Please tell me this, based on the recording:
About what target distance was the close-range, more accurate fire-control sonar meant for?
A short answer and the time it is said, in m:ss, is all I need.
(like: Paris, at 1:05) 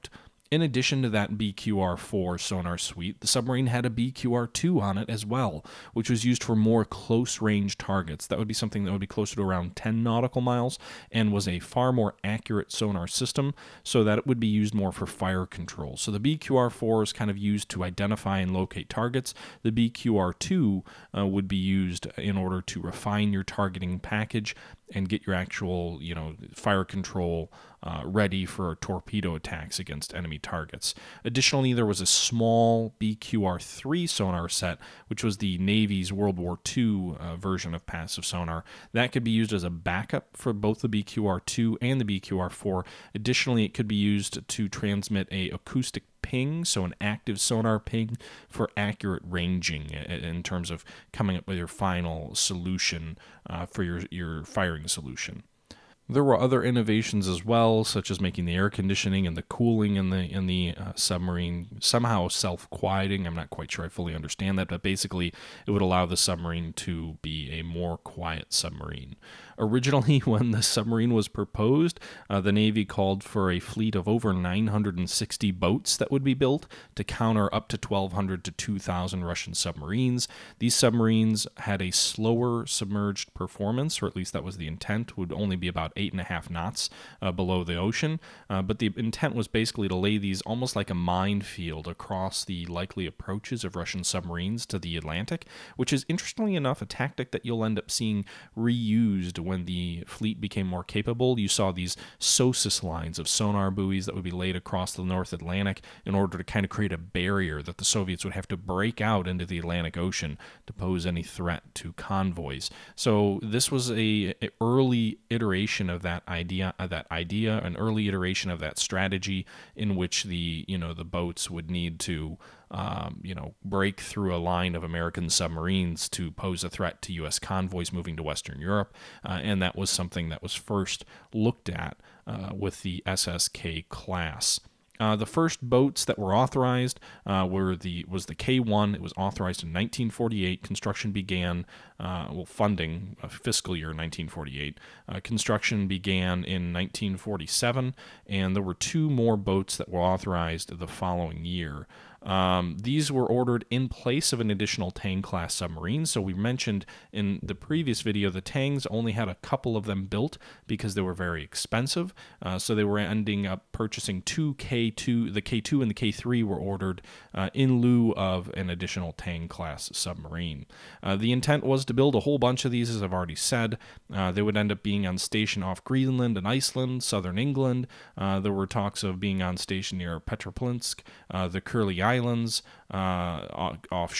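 10 nautical miles, at 0:09.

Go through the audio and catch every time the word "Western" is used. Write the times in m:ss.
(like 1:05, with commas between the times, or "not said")
2:08.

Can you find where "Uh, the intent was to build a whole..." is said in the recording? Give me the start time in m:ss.
2:51.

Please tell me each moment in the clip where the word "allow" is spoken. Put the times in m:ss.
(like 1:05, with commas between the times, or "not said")
1:05.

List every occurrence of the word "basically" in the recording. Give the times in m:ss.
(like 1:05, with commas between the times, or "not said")
1:04, 1:29.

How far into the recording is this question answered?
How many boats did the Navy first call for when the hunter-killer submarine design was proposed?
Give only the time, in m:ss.
1:14.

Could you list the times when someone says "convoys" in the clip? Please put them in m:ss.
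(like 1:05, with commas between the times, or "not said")
1:51, 2:07.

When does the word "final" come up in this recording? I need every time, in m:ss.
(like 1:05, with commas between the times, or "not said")
0:51.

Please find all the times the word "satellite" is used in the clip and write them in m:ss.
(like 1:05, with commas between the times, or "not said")
not said.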